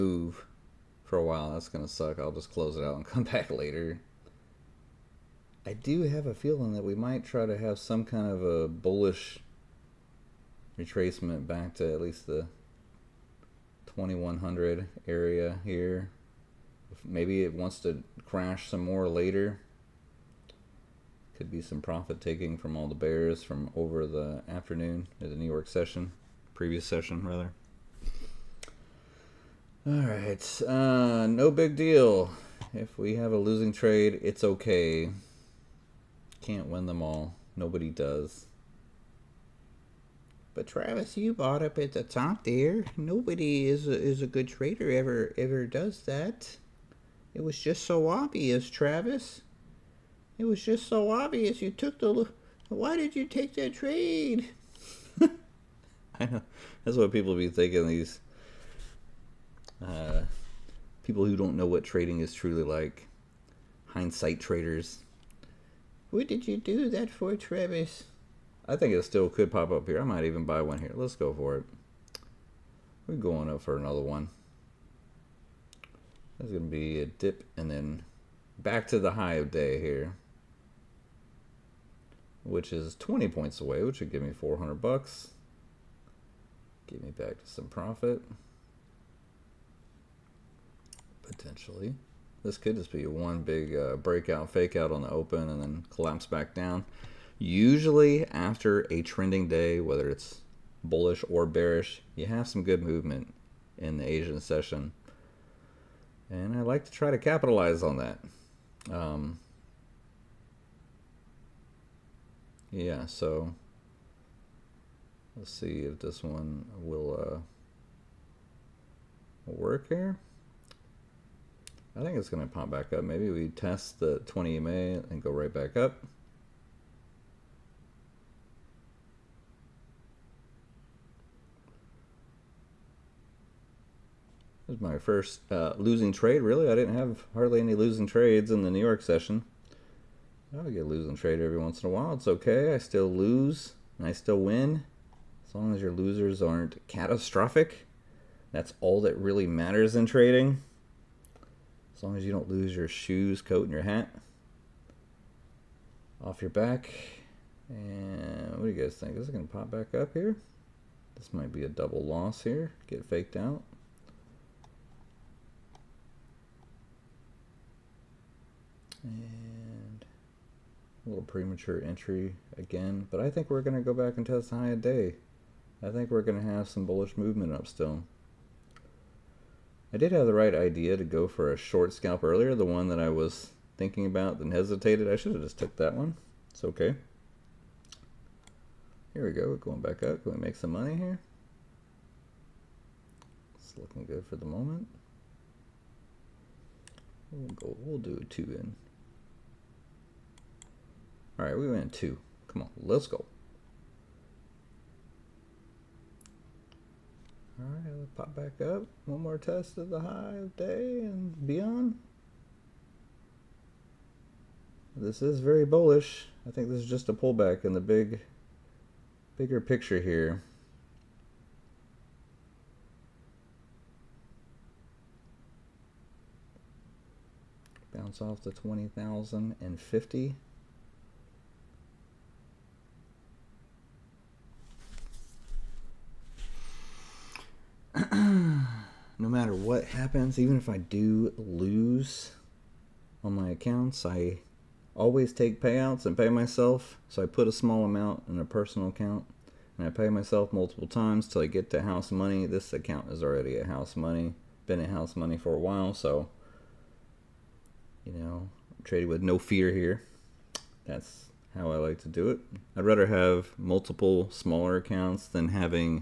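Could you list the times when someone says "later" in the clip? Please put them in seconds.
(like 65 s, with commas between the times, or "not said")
3 s, 19 s.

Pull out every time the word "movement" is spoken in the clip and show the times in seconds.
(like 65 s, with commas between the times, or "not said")
102 s, 177 s.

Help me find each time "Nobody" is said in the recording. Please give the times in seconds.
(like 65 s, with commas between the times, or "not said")
37 s, 42 s.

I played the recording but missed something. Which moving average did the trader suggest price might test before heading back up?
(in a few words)
20 EMA.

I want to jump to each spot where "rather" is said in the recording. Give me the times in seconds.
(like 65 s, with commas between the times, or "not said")
27 s, 262 s.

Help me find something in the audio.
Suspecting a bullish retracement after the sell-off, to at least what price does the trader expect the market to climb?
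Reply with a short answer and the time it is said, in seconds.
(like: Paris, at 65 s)
2100, at 13 s.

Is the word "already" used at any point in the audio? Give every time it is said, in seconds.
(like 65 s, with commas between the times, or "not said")
253 s.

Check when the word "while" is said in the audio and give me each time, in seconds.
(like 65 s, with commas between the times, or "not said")
1 s, 141 s, 255 s.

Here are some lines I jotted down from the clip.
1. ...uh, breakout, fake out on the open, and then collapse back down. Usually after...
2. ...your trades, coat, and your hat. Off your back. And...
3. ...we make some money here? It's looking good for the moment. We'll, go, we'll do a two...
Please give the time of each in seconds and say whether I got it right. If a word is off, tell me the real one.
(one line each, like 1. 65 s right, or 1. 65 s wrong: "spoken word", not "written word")
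1. 93 s right
2. 152 s wrong: "shoes", not "trades"
3. 190 s right.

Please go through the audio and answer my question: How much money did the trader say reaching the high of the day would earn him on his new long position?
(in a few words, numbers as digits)
400 bucks.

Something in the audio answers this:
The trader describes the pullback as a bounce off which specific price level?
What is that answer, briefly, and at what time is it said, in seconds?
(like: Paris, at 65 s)
20,050, at 228 s.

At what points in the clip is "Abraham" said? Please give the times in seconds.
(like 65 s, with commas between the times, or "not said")
not said.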